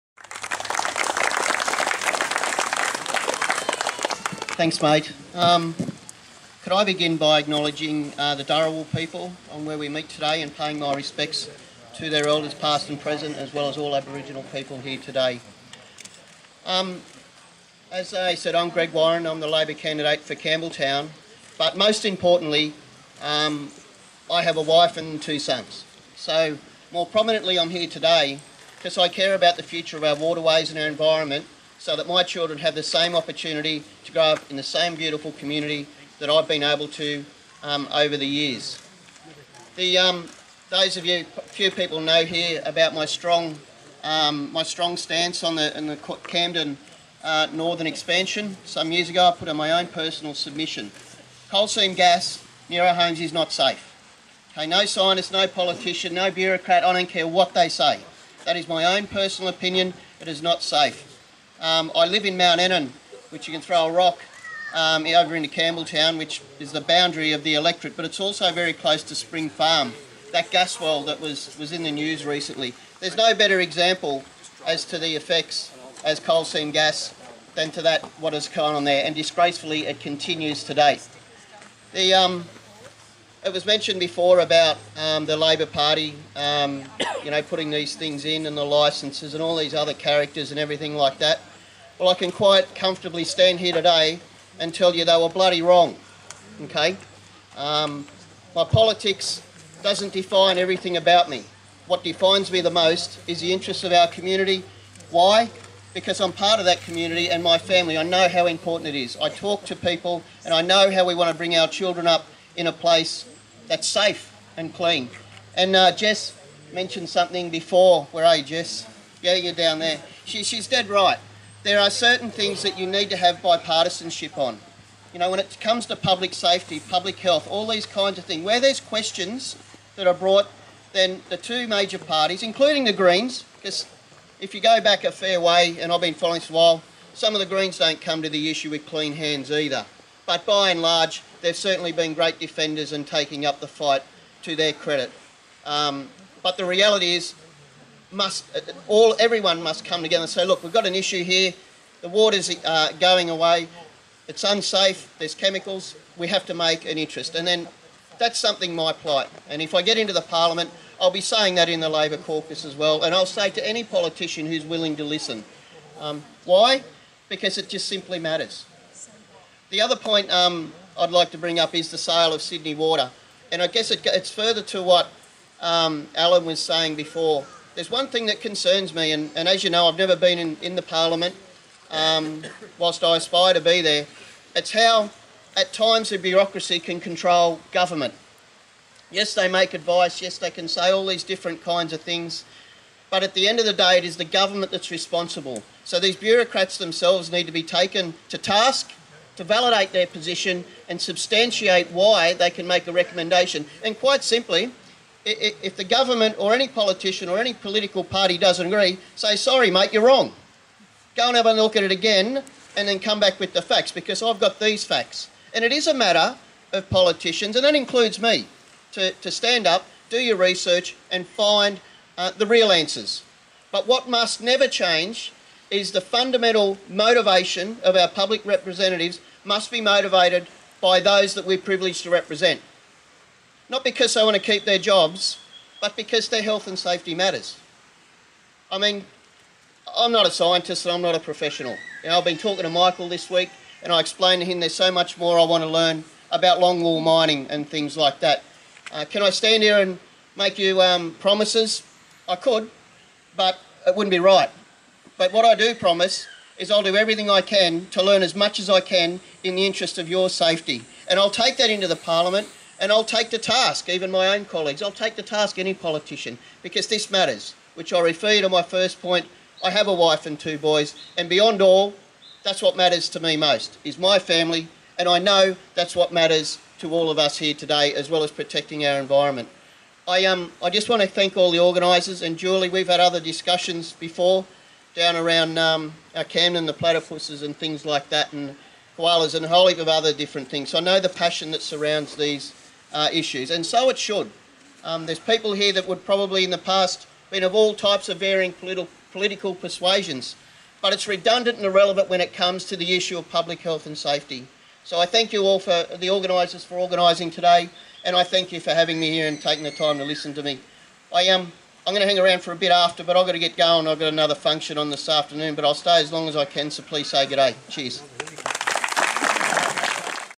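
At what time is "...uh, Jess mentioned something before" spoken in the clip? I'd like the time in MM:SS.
01:55.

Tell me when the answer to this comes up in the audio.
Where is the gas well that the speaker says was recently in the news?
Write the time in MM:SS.
01:09.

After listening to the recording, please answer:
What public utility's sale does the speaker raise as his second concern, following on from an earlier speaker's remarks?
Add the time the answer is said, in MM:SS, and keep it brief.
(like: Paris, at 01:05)
Sydney Water, at 02:52.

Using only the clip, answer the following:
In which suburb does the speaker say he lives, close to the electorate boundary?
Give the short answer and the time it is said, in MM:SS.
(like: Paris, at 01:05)
Mount Annan, at 01:02.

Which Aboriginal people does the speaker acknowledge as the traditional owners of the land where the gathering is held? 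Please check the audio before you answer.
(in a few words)
Dharawal.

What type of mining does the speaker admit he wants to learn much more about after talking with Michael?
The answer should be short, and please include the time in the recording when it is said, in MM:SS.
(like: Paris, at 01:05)
Longwall mining, at 04:06.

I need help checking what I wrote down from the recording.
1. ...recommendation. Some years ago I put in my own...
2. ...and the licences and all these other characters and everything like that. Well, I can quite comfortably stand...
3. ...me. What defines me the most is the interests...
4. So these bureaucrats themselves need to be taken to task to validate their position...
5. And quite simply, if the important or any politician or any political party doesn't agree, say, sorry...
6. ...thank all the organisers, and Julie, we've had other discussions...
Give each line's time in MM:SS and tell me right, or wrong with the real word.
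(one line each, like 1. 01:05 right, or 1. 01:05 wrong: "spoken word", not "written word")
1. 00:47 wrong: "expansion", not "recommendation"
2. 01:28 right
3. 01:41 right
4. 03:15 right
5. 03:23 wrong: "government", not "important"
6. 04:41 right.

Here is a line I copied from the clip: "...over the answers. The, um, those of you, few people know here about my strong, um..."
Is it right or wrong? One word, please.
wrong.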